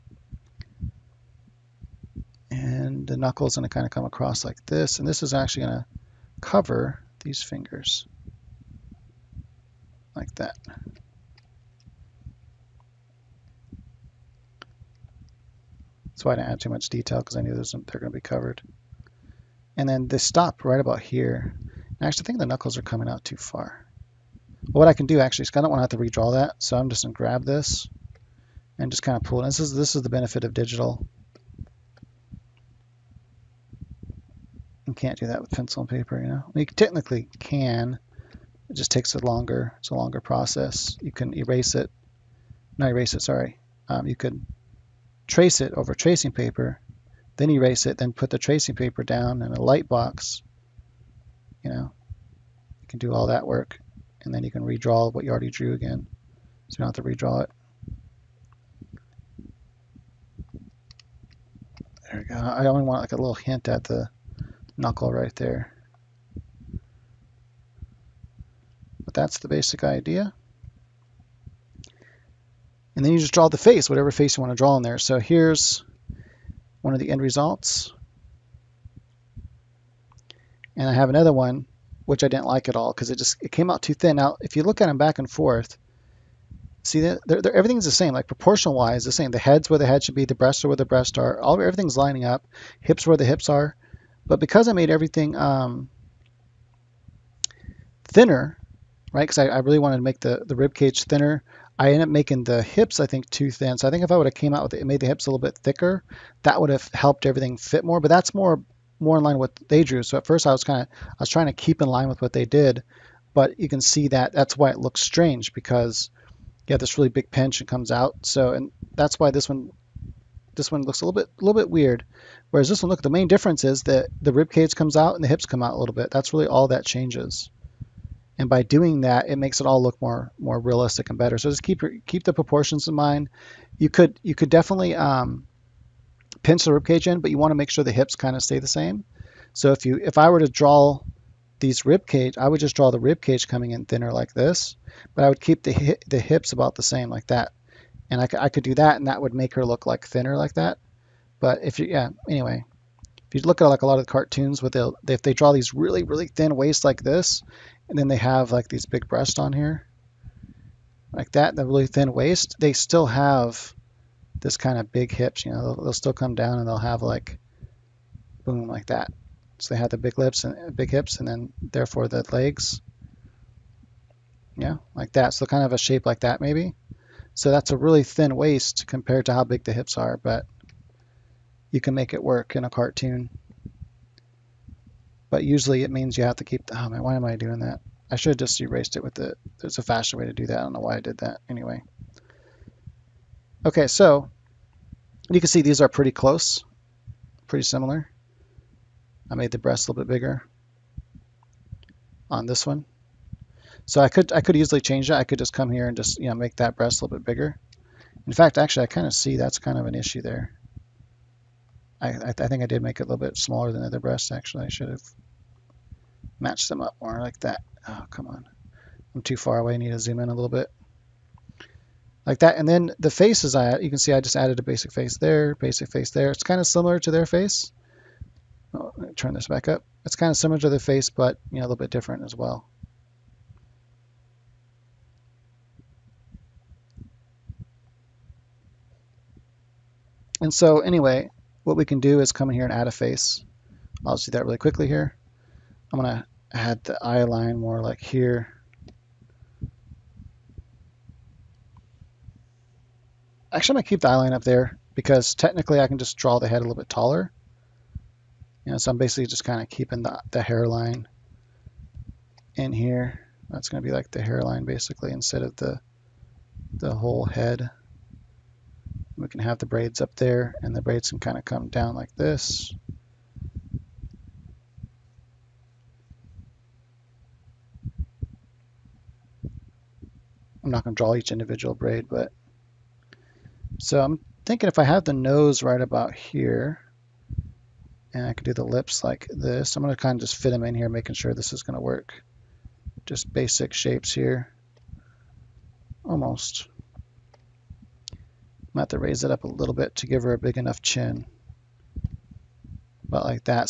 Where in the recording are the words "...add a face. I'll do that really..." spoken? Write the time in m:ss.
4:02.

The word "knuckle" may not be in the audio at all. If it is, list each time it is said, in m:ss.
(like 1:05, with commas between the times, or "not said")
0:03, 0:22, 1:04.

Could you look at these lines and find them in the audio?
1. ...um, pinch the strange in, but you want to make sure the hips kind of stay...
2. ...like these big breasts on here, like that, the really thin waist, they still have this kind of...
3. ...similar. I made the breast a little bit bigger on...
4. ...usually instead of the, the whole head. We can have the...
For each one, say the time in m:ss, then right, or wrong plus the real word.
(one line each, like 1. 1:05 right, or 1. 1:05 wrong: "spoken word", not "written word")
1. 2:14 wrong: "ribcage", not "strange"
2. 2:38 right
3. 3:17 right
4. 4:24 wrong: "basically", not "usually".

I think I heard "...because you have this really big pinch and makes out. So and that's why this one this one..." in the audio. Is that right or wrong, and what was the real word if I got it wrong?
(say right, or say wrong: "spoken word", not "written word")
wrong: "comes", not "makes".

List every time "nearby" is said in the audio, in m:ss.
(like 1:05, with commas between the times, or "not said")
not said.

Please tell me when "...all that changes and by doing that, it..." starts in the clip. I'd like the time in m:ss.
2:06.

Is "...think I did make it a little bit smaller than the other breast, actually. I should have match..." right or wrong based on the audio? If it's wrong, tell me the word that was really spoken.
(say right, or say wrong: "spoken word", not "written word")
right.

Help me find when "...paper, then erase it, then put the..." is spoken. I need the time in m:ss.
0:46.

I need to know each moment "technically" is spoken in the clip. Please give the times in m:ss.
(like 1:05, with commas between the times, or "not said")
0:36, 4:15.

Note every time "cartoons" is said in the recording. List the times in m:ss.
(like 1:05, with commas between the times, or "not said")
2:34, 3:02.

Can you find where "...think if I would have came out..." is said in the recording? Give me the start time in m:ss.
1:43.